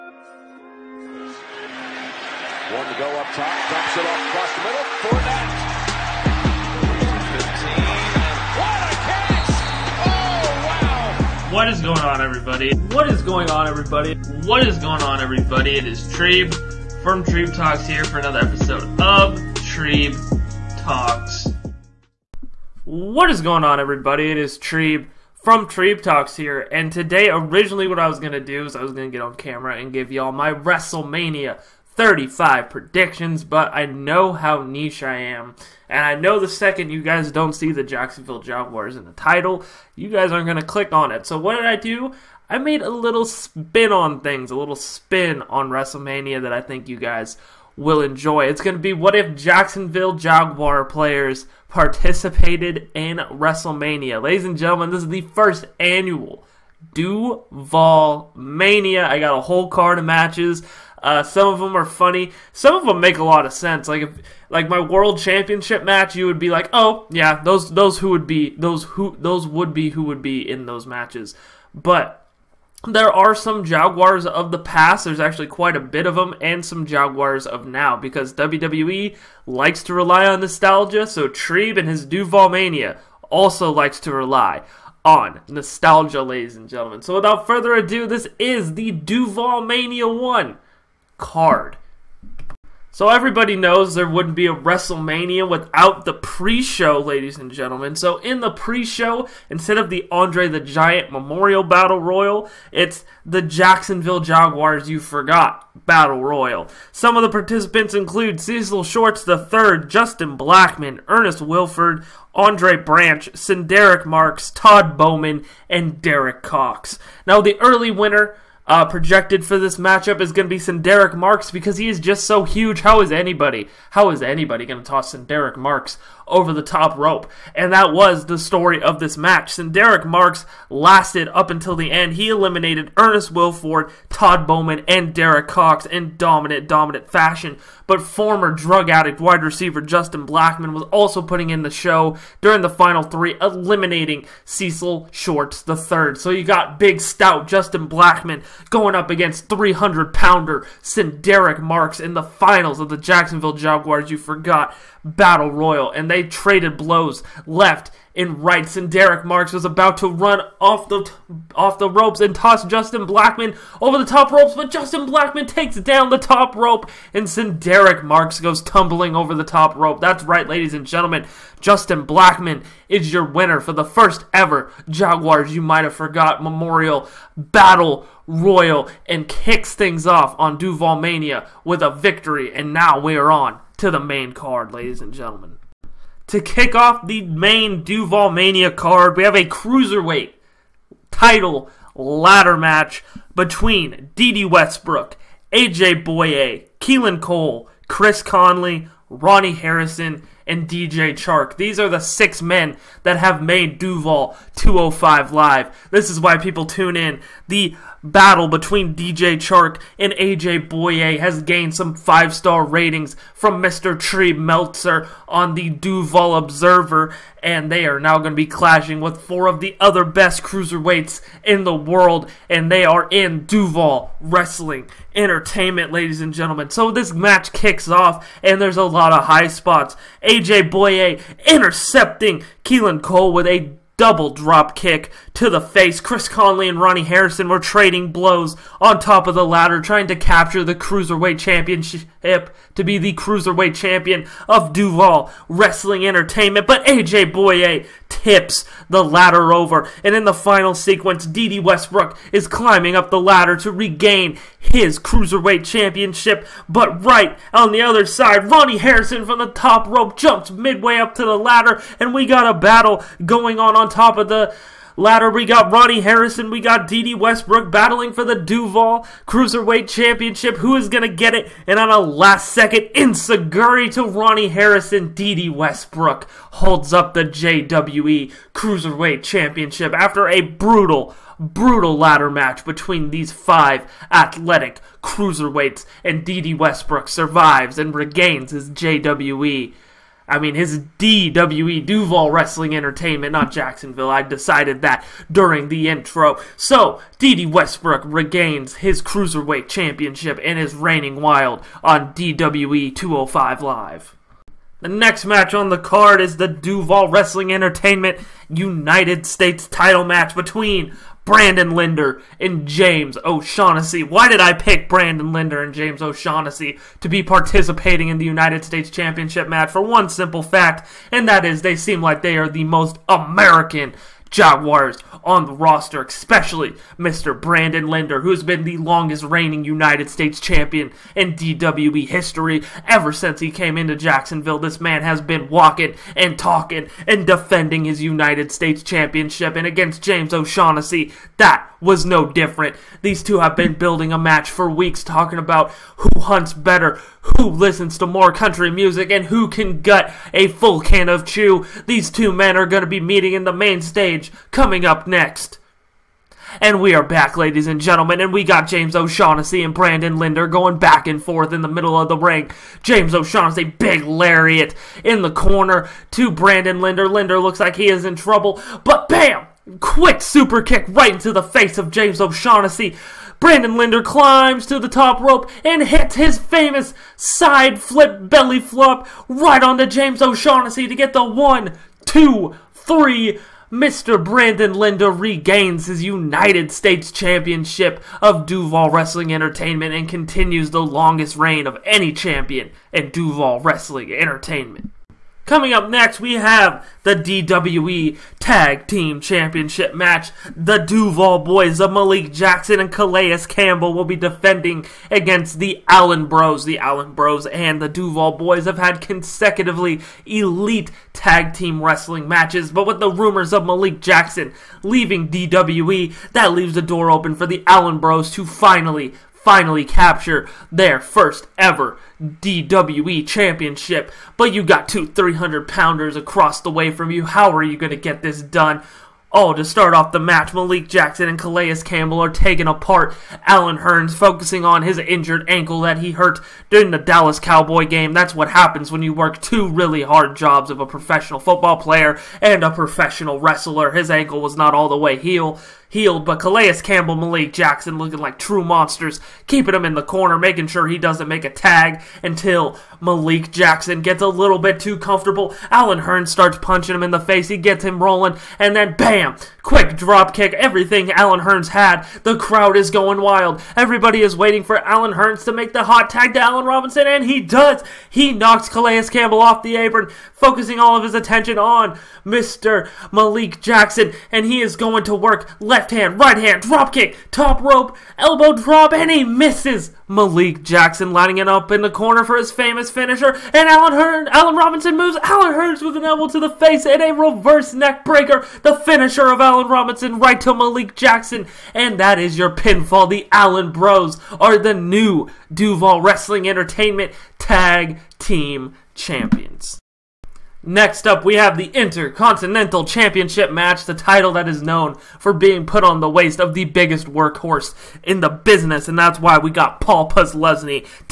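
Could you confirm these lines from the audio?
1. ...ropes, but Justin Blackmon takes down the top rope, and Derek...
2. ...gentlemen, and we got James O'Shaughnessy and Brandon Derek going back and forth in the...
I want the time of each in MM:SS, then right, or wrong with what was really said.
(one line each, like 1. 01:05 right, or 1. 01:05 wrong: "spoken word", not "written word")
1. 02:44 right
2. 05:57 wrong: "Linder", not "Derek".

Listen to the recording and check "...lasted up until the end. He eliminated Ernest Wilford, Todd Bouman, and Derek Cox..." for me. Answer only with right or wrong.
right.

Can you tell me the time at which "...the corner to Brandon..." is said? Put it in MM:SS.
06:05.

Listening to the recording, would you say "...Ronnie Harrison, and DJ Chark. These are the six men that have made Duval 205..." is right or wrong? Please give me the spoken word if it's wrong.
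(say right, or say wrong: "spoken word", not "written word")
right.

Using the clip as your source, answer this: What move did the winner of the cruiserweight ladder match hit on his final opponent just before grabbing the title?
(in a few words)
enzuigiri.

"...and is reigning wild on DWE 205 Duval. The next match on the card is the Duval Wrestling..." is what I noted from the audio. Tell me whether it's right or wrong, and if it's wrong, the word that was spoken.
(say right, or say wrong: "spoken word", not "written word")
wrong: "Live", not "Duval".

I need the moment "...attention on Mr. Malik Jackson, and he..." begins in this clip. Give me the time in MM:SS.
07:51.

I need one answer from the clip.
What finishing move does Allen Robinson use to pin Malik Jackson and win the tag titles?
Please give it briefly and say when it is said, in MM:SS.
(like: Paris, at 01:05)
reverse neck breaker, at 08:07.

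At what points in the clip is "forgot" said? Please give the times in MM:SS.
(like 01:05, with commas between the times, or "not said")
01:44, 02:34, 02:55.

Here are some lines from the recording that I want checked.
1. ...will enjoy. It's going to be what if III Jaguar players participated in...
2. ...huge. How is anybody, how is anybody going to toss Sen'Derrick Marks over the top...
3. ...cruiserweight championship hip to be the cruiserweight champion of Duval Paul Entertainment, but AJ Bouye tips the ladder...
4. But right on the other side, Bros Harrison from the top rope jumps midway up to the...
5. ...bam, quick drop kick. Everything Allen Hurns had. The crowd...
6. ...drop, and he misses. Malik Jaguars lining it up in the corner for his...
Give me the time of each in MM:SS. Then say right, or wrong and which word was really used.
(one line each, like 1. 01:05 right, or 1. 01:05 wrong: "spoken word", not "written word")
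1. 00:47 wrong: "Jacksonville", not "III"
2. 02:02 right
3. 04:00 wrong: "Wrestling", not "Paul"
4. 04:16 wrong: "Ronnie", not "Bros"
5. 07:38 right
6. 07:58 wrong: "Jackson", not "Jaguars".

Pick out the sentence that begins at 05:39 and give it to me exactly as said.
And against James O'Shaughnessy, that was no different.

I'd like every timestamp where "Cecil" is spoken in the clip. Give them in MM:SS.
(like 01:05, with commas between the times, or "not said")
01:48, 02:24.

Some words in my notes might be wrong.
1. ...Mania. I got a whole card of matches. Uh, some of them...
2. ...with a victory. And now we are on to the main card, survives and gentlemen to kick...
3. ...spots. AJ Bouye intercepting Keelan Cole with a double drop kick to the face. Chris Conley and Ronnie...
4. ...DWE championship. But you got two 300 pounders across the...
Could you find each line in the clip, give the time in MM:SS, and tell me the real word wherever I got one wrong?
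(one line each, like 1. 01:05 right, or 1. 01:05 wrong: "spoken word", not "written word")
1. 00:58 right
2. 03:01 wrong: "ladies", not "survives"
3. 03:49 right
4. 07:02 right.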